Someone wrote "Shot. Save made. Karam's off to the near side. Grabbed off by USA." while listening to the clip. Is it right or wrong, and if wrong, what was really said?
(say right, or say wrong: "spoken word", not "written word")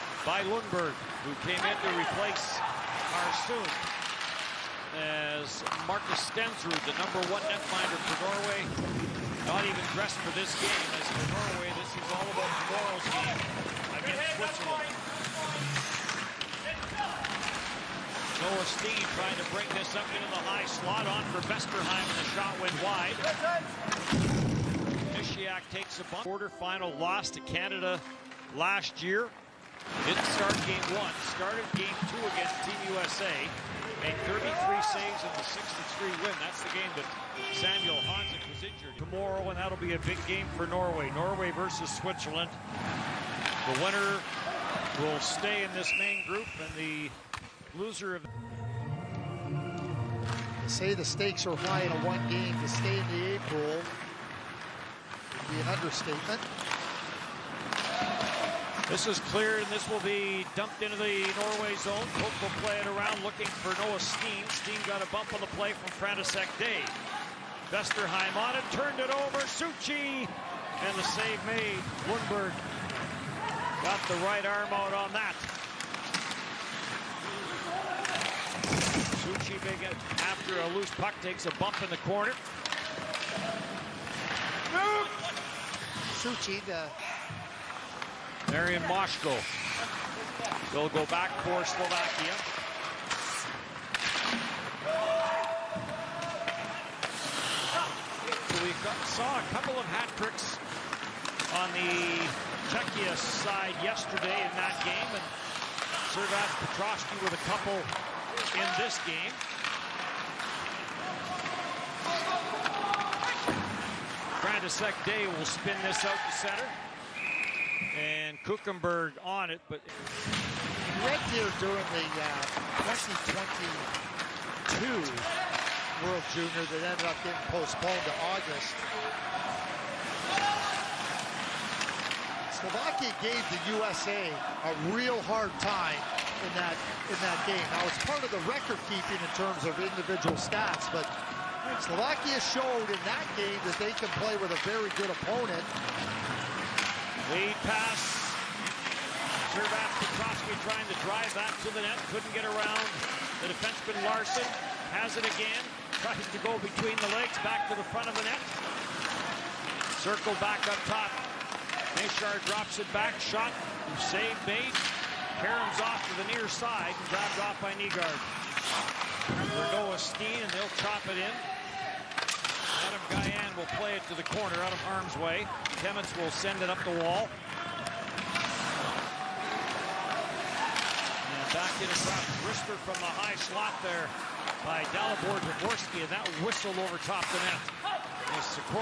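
wrong: "Nygard", not "USA".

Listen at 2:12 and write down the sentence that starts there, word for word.
Slovakia gave the USA a real hard time in that in that game.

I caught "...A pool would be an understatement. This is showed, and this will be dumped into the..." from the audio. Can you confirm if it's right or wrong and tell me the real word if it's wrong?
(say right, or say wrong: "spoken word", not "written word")
wrong: "cleared", not "showed".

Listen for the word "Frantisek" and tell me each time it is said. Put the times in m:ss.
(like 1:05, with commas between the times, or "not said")
1:05, 1:54.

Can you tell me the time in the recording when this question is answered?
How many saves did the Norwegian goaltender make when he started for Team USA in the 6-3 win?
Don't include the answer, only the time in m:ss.
0:34.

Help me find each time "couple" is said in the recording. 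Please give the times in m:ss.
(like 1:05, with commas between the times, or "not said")
1:39, 1:47.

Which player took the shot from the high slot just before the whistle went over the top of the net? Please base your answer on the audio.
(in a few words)
Dalibor Dvorsky.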